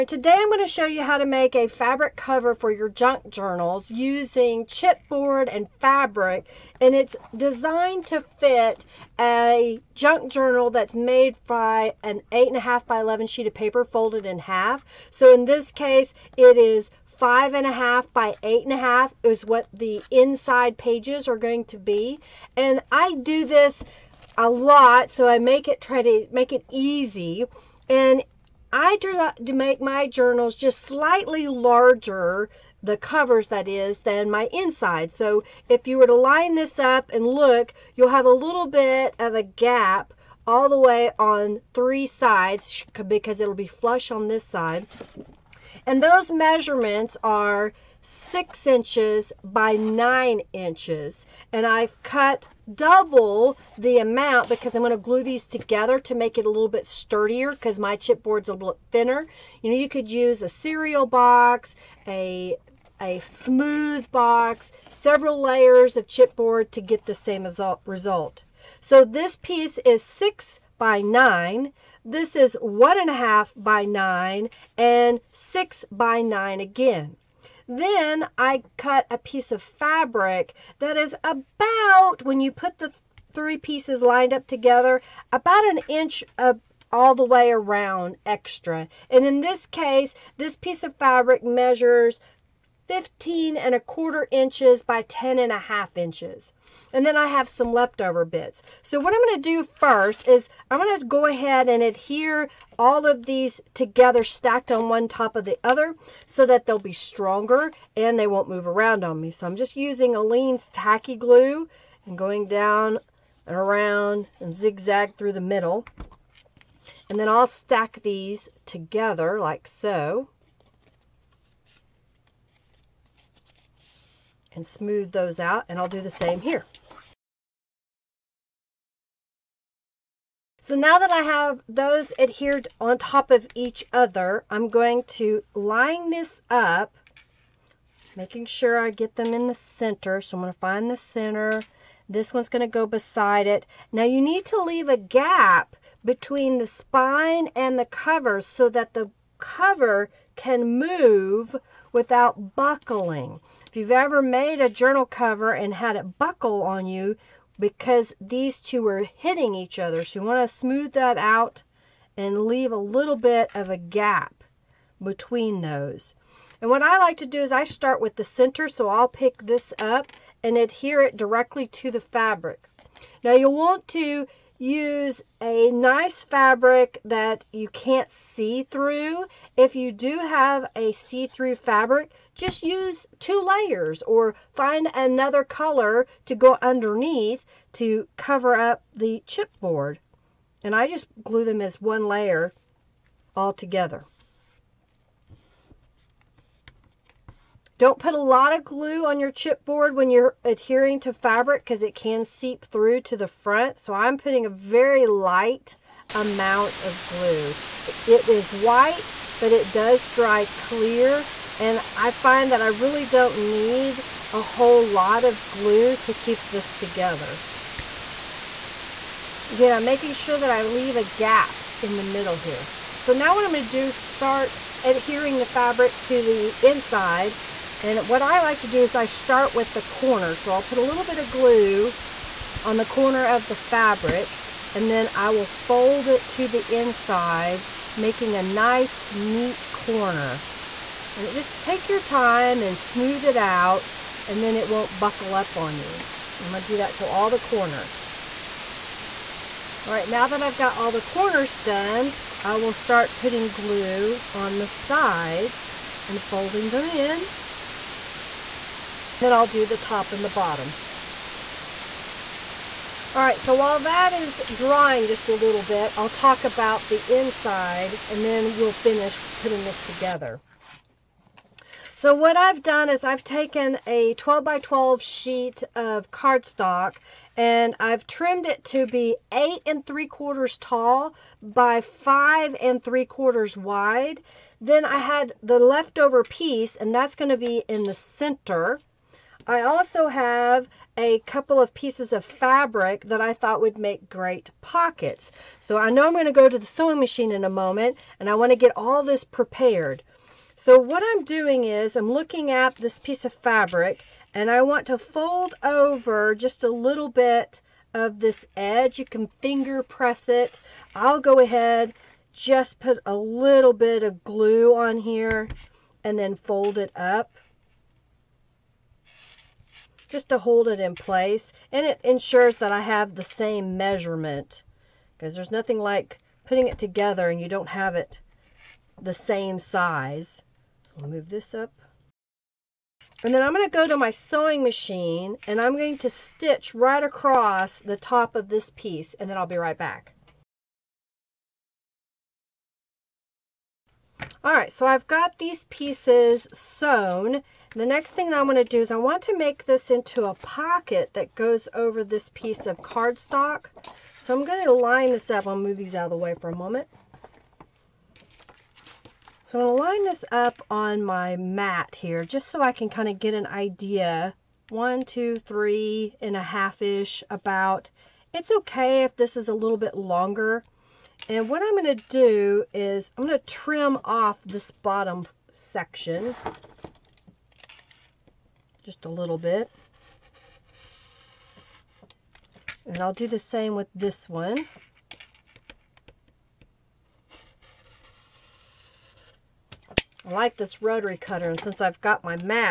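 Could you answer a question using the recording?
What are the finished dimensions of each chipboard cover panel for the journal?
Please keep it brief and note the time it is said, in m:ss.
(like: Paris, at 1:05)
6 by 9 inches, at 0:48.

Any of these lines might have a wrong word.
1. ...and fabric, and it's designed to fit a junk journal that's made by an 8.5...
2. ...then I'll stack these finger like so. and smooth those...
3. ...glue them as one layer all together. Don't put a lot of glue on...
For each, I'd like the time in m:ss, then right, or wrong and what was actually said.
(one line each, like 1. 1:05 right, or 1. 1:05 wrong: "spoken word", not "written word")
1. 0:05 right
2. 1:57 wrong: "together", not "finger"
3. 3:11 right.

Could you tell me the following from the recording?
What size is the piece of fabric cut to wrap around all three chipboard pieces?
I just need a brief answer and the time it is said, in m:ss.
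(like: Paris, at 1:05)
15.25 by 10.5 inches, at 1:32.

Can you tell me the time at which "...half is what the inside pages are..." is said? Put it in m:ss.
0:18.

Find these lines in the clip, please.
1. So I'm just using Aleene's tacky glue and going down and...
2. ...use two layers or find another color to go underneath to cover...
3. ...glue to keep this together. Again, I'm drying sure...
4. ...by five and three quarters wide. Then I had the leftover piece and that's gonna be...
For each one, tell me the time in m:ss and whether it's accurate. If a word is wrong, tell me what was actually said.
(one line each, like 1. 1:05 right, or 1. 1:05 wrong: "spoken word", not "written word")
1. 1:49 right
2. 3:02 right
3. 3:35 wrong: "making", not "drying"
4. 4:41 right.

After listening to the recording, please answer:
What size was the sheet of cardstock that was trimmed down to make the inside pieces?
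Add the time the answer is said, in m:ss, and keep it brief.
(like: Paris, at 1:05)
12 by 12, at 4:34.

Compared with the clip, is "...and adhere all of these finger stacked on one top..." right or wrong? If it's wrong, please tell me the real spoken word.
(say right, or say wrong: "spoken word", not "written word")
wrong: "together", not "finger".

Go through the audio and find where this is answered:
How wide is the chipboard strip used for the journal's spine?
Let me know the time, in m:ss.
1:12.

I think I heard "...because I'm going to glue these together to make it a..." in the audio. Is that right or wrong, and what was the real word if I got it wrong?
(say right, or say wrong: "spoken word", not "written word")
right.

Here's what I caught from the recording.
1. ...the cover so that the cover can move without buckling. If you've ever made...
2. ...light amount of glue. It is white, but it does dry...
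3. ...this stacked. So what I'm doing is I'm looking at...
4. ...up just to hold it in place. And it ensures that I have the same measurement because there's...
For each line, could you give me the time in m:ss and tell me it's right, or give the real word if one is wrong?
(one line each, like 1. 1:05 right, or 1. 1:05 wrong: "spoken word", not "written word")
1. 2:27 right
2. 3:25 right
3. 4:59 wrong: "prepared", not "stacked"
4. 5:16 right.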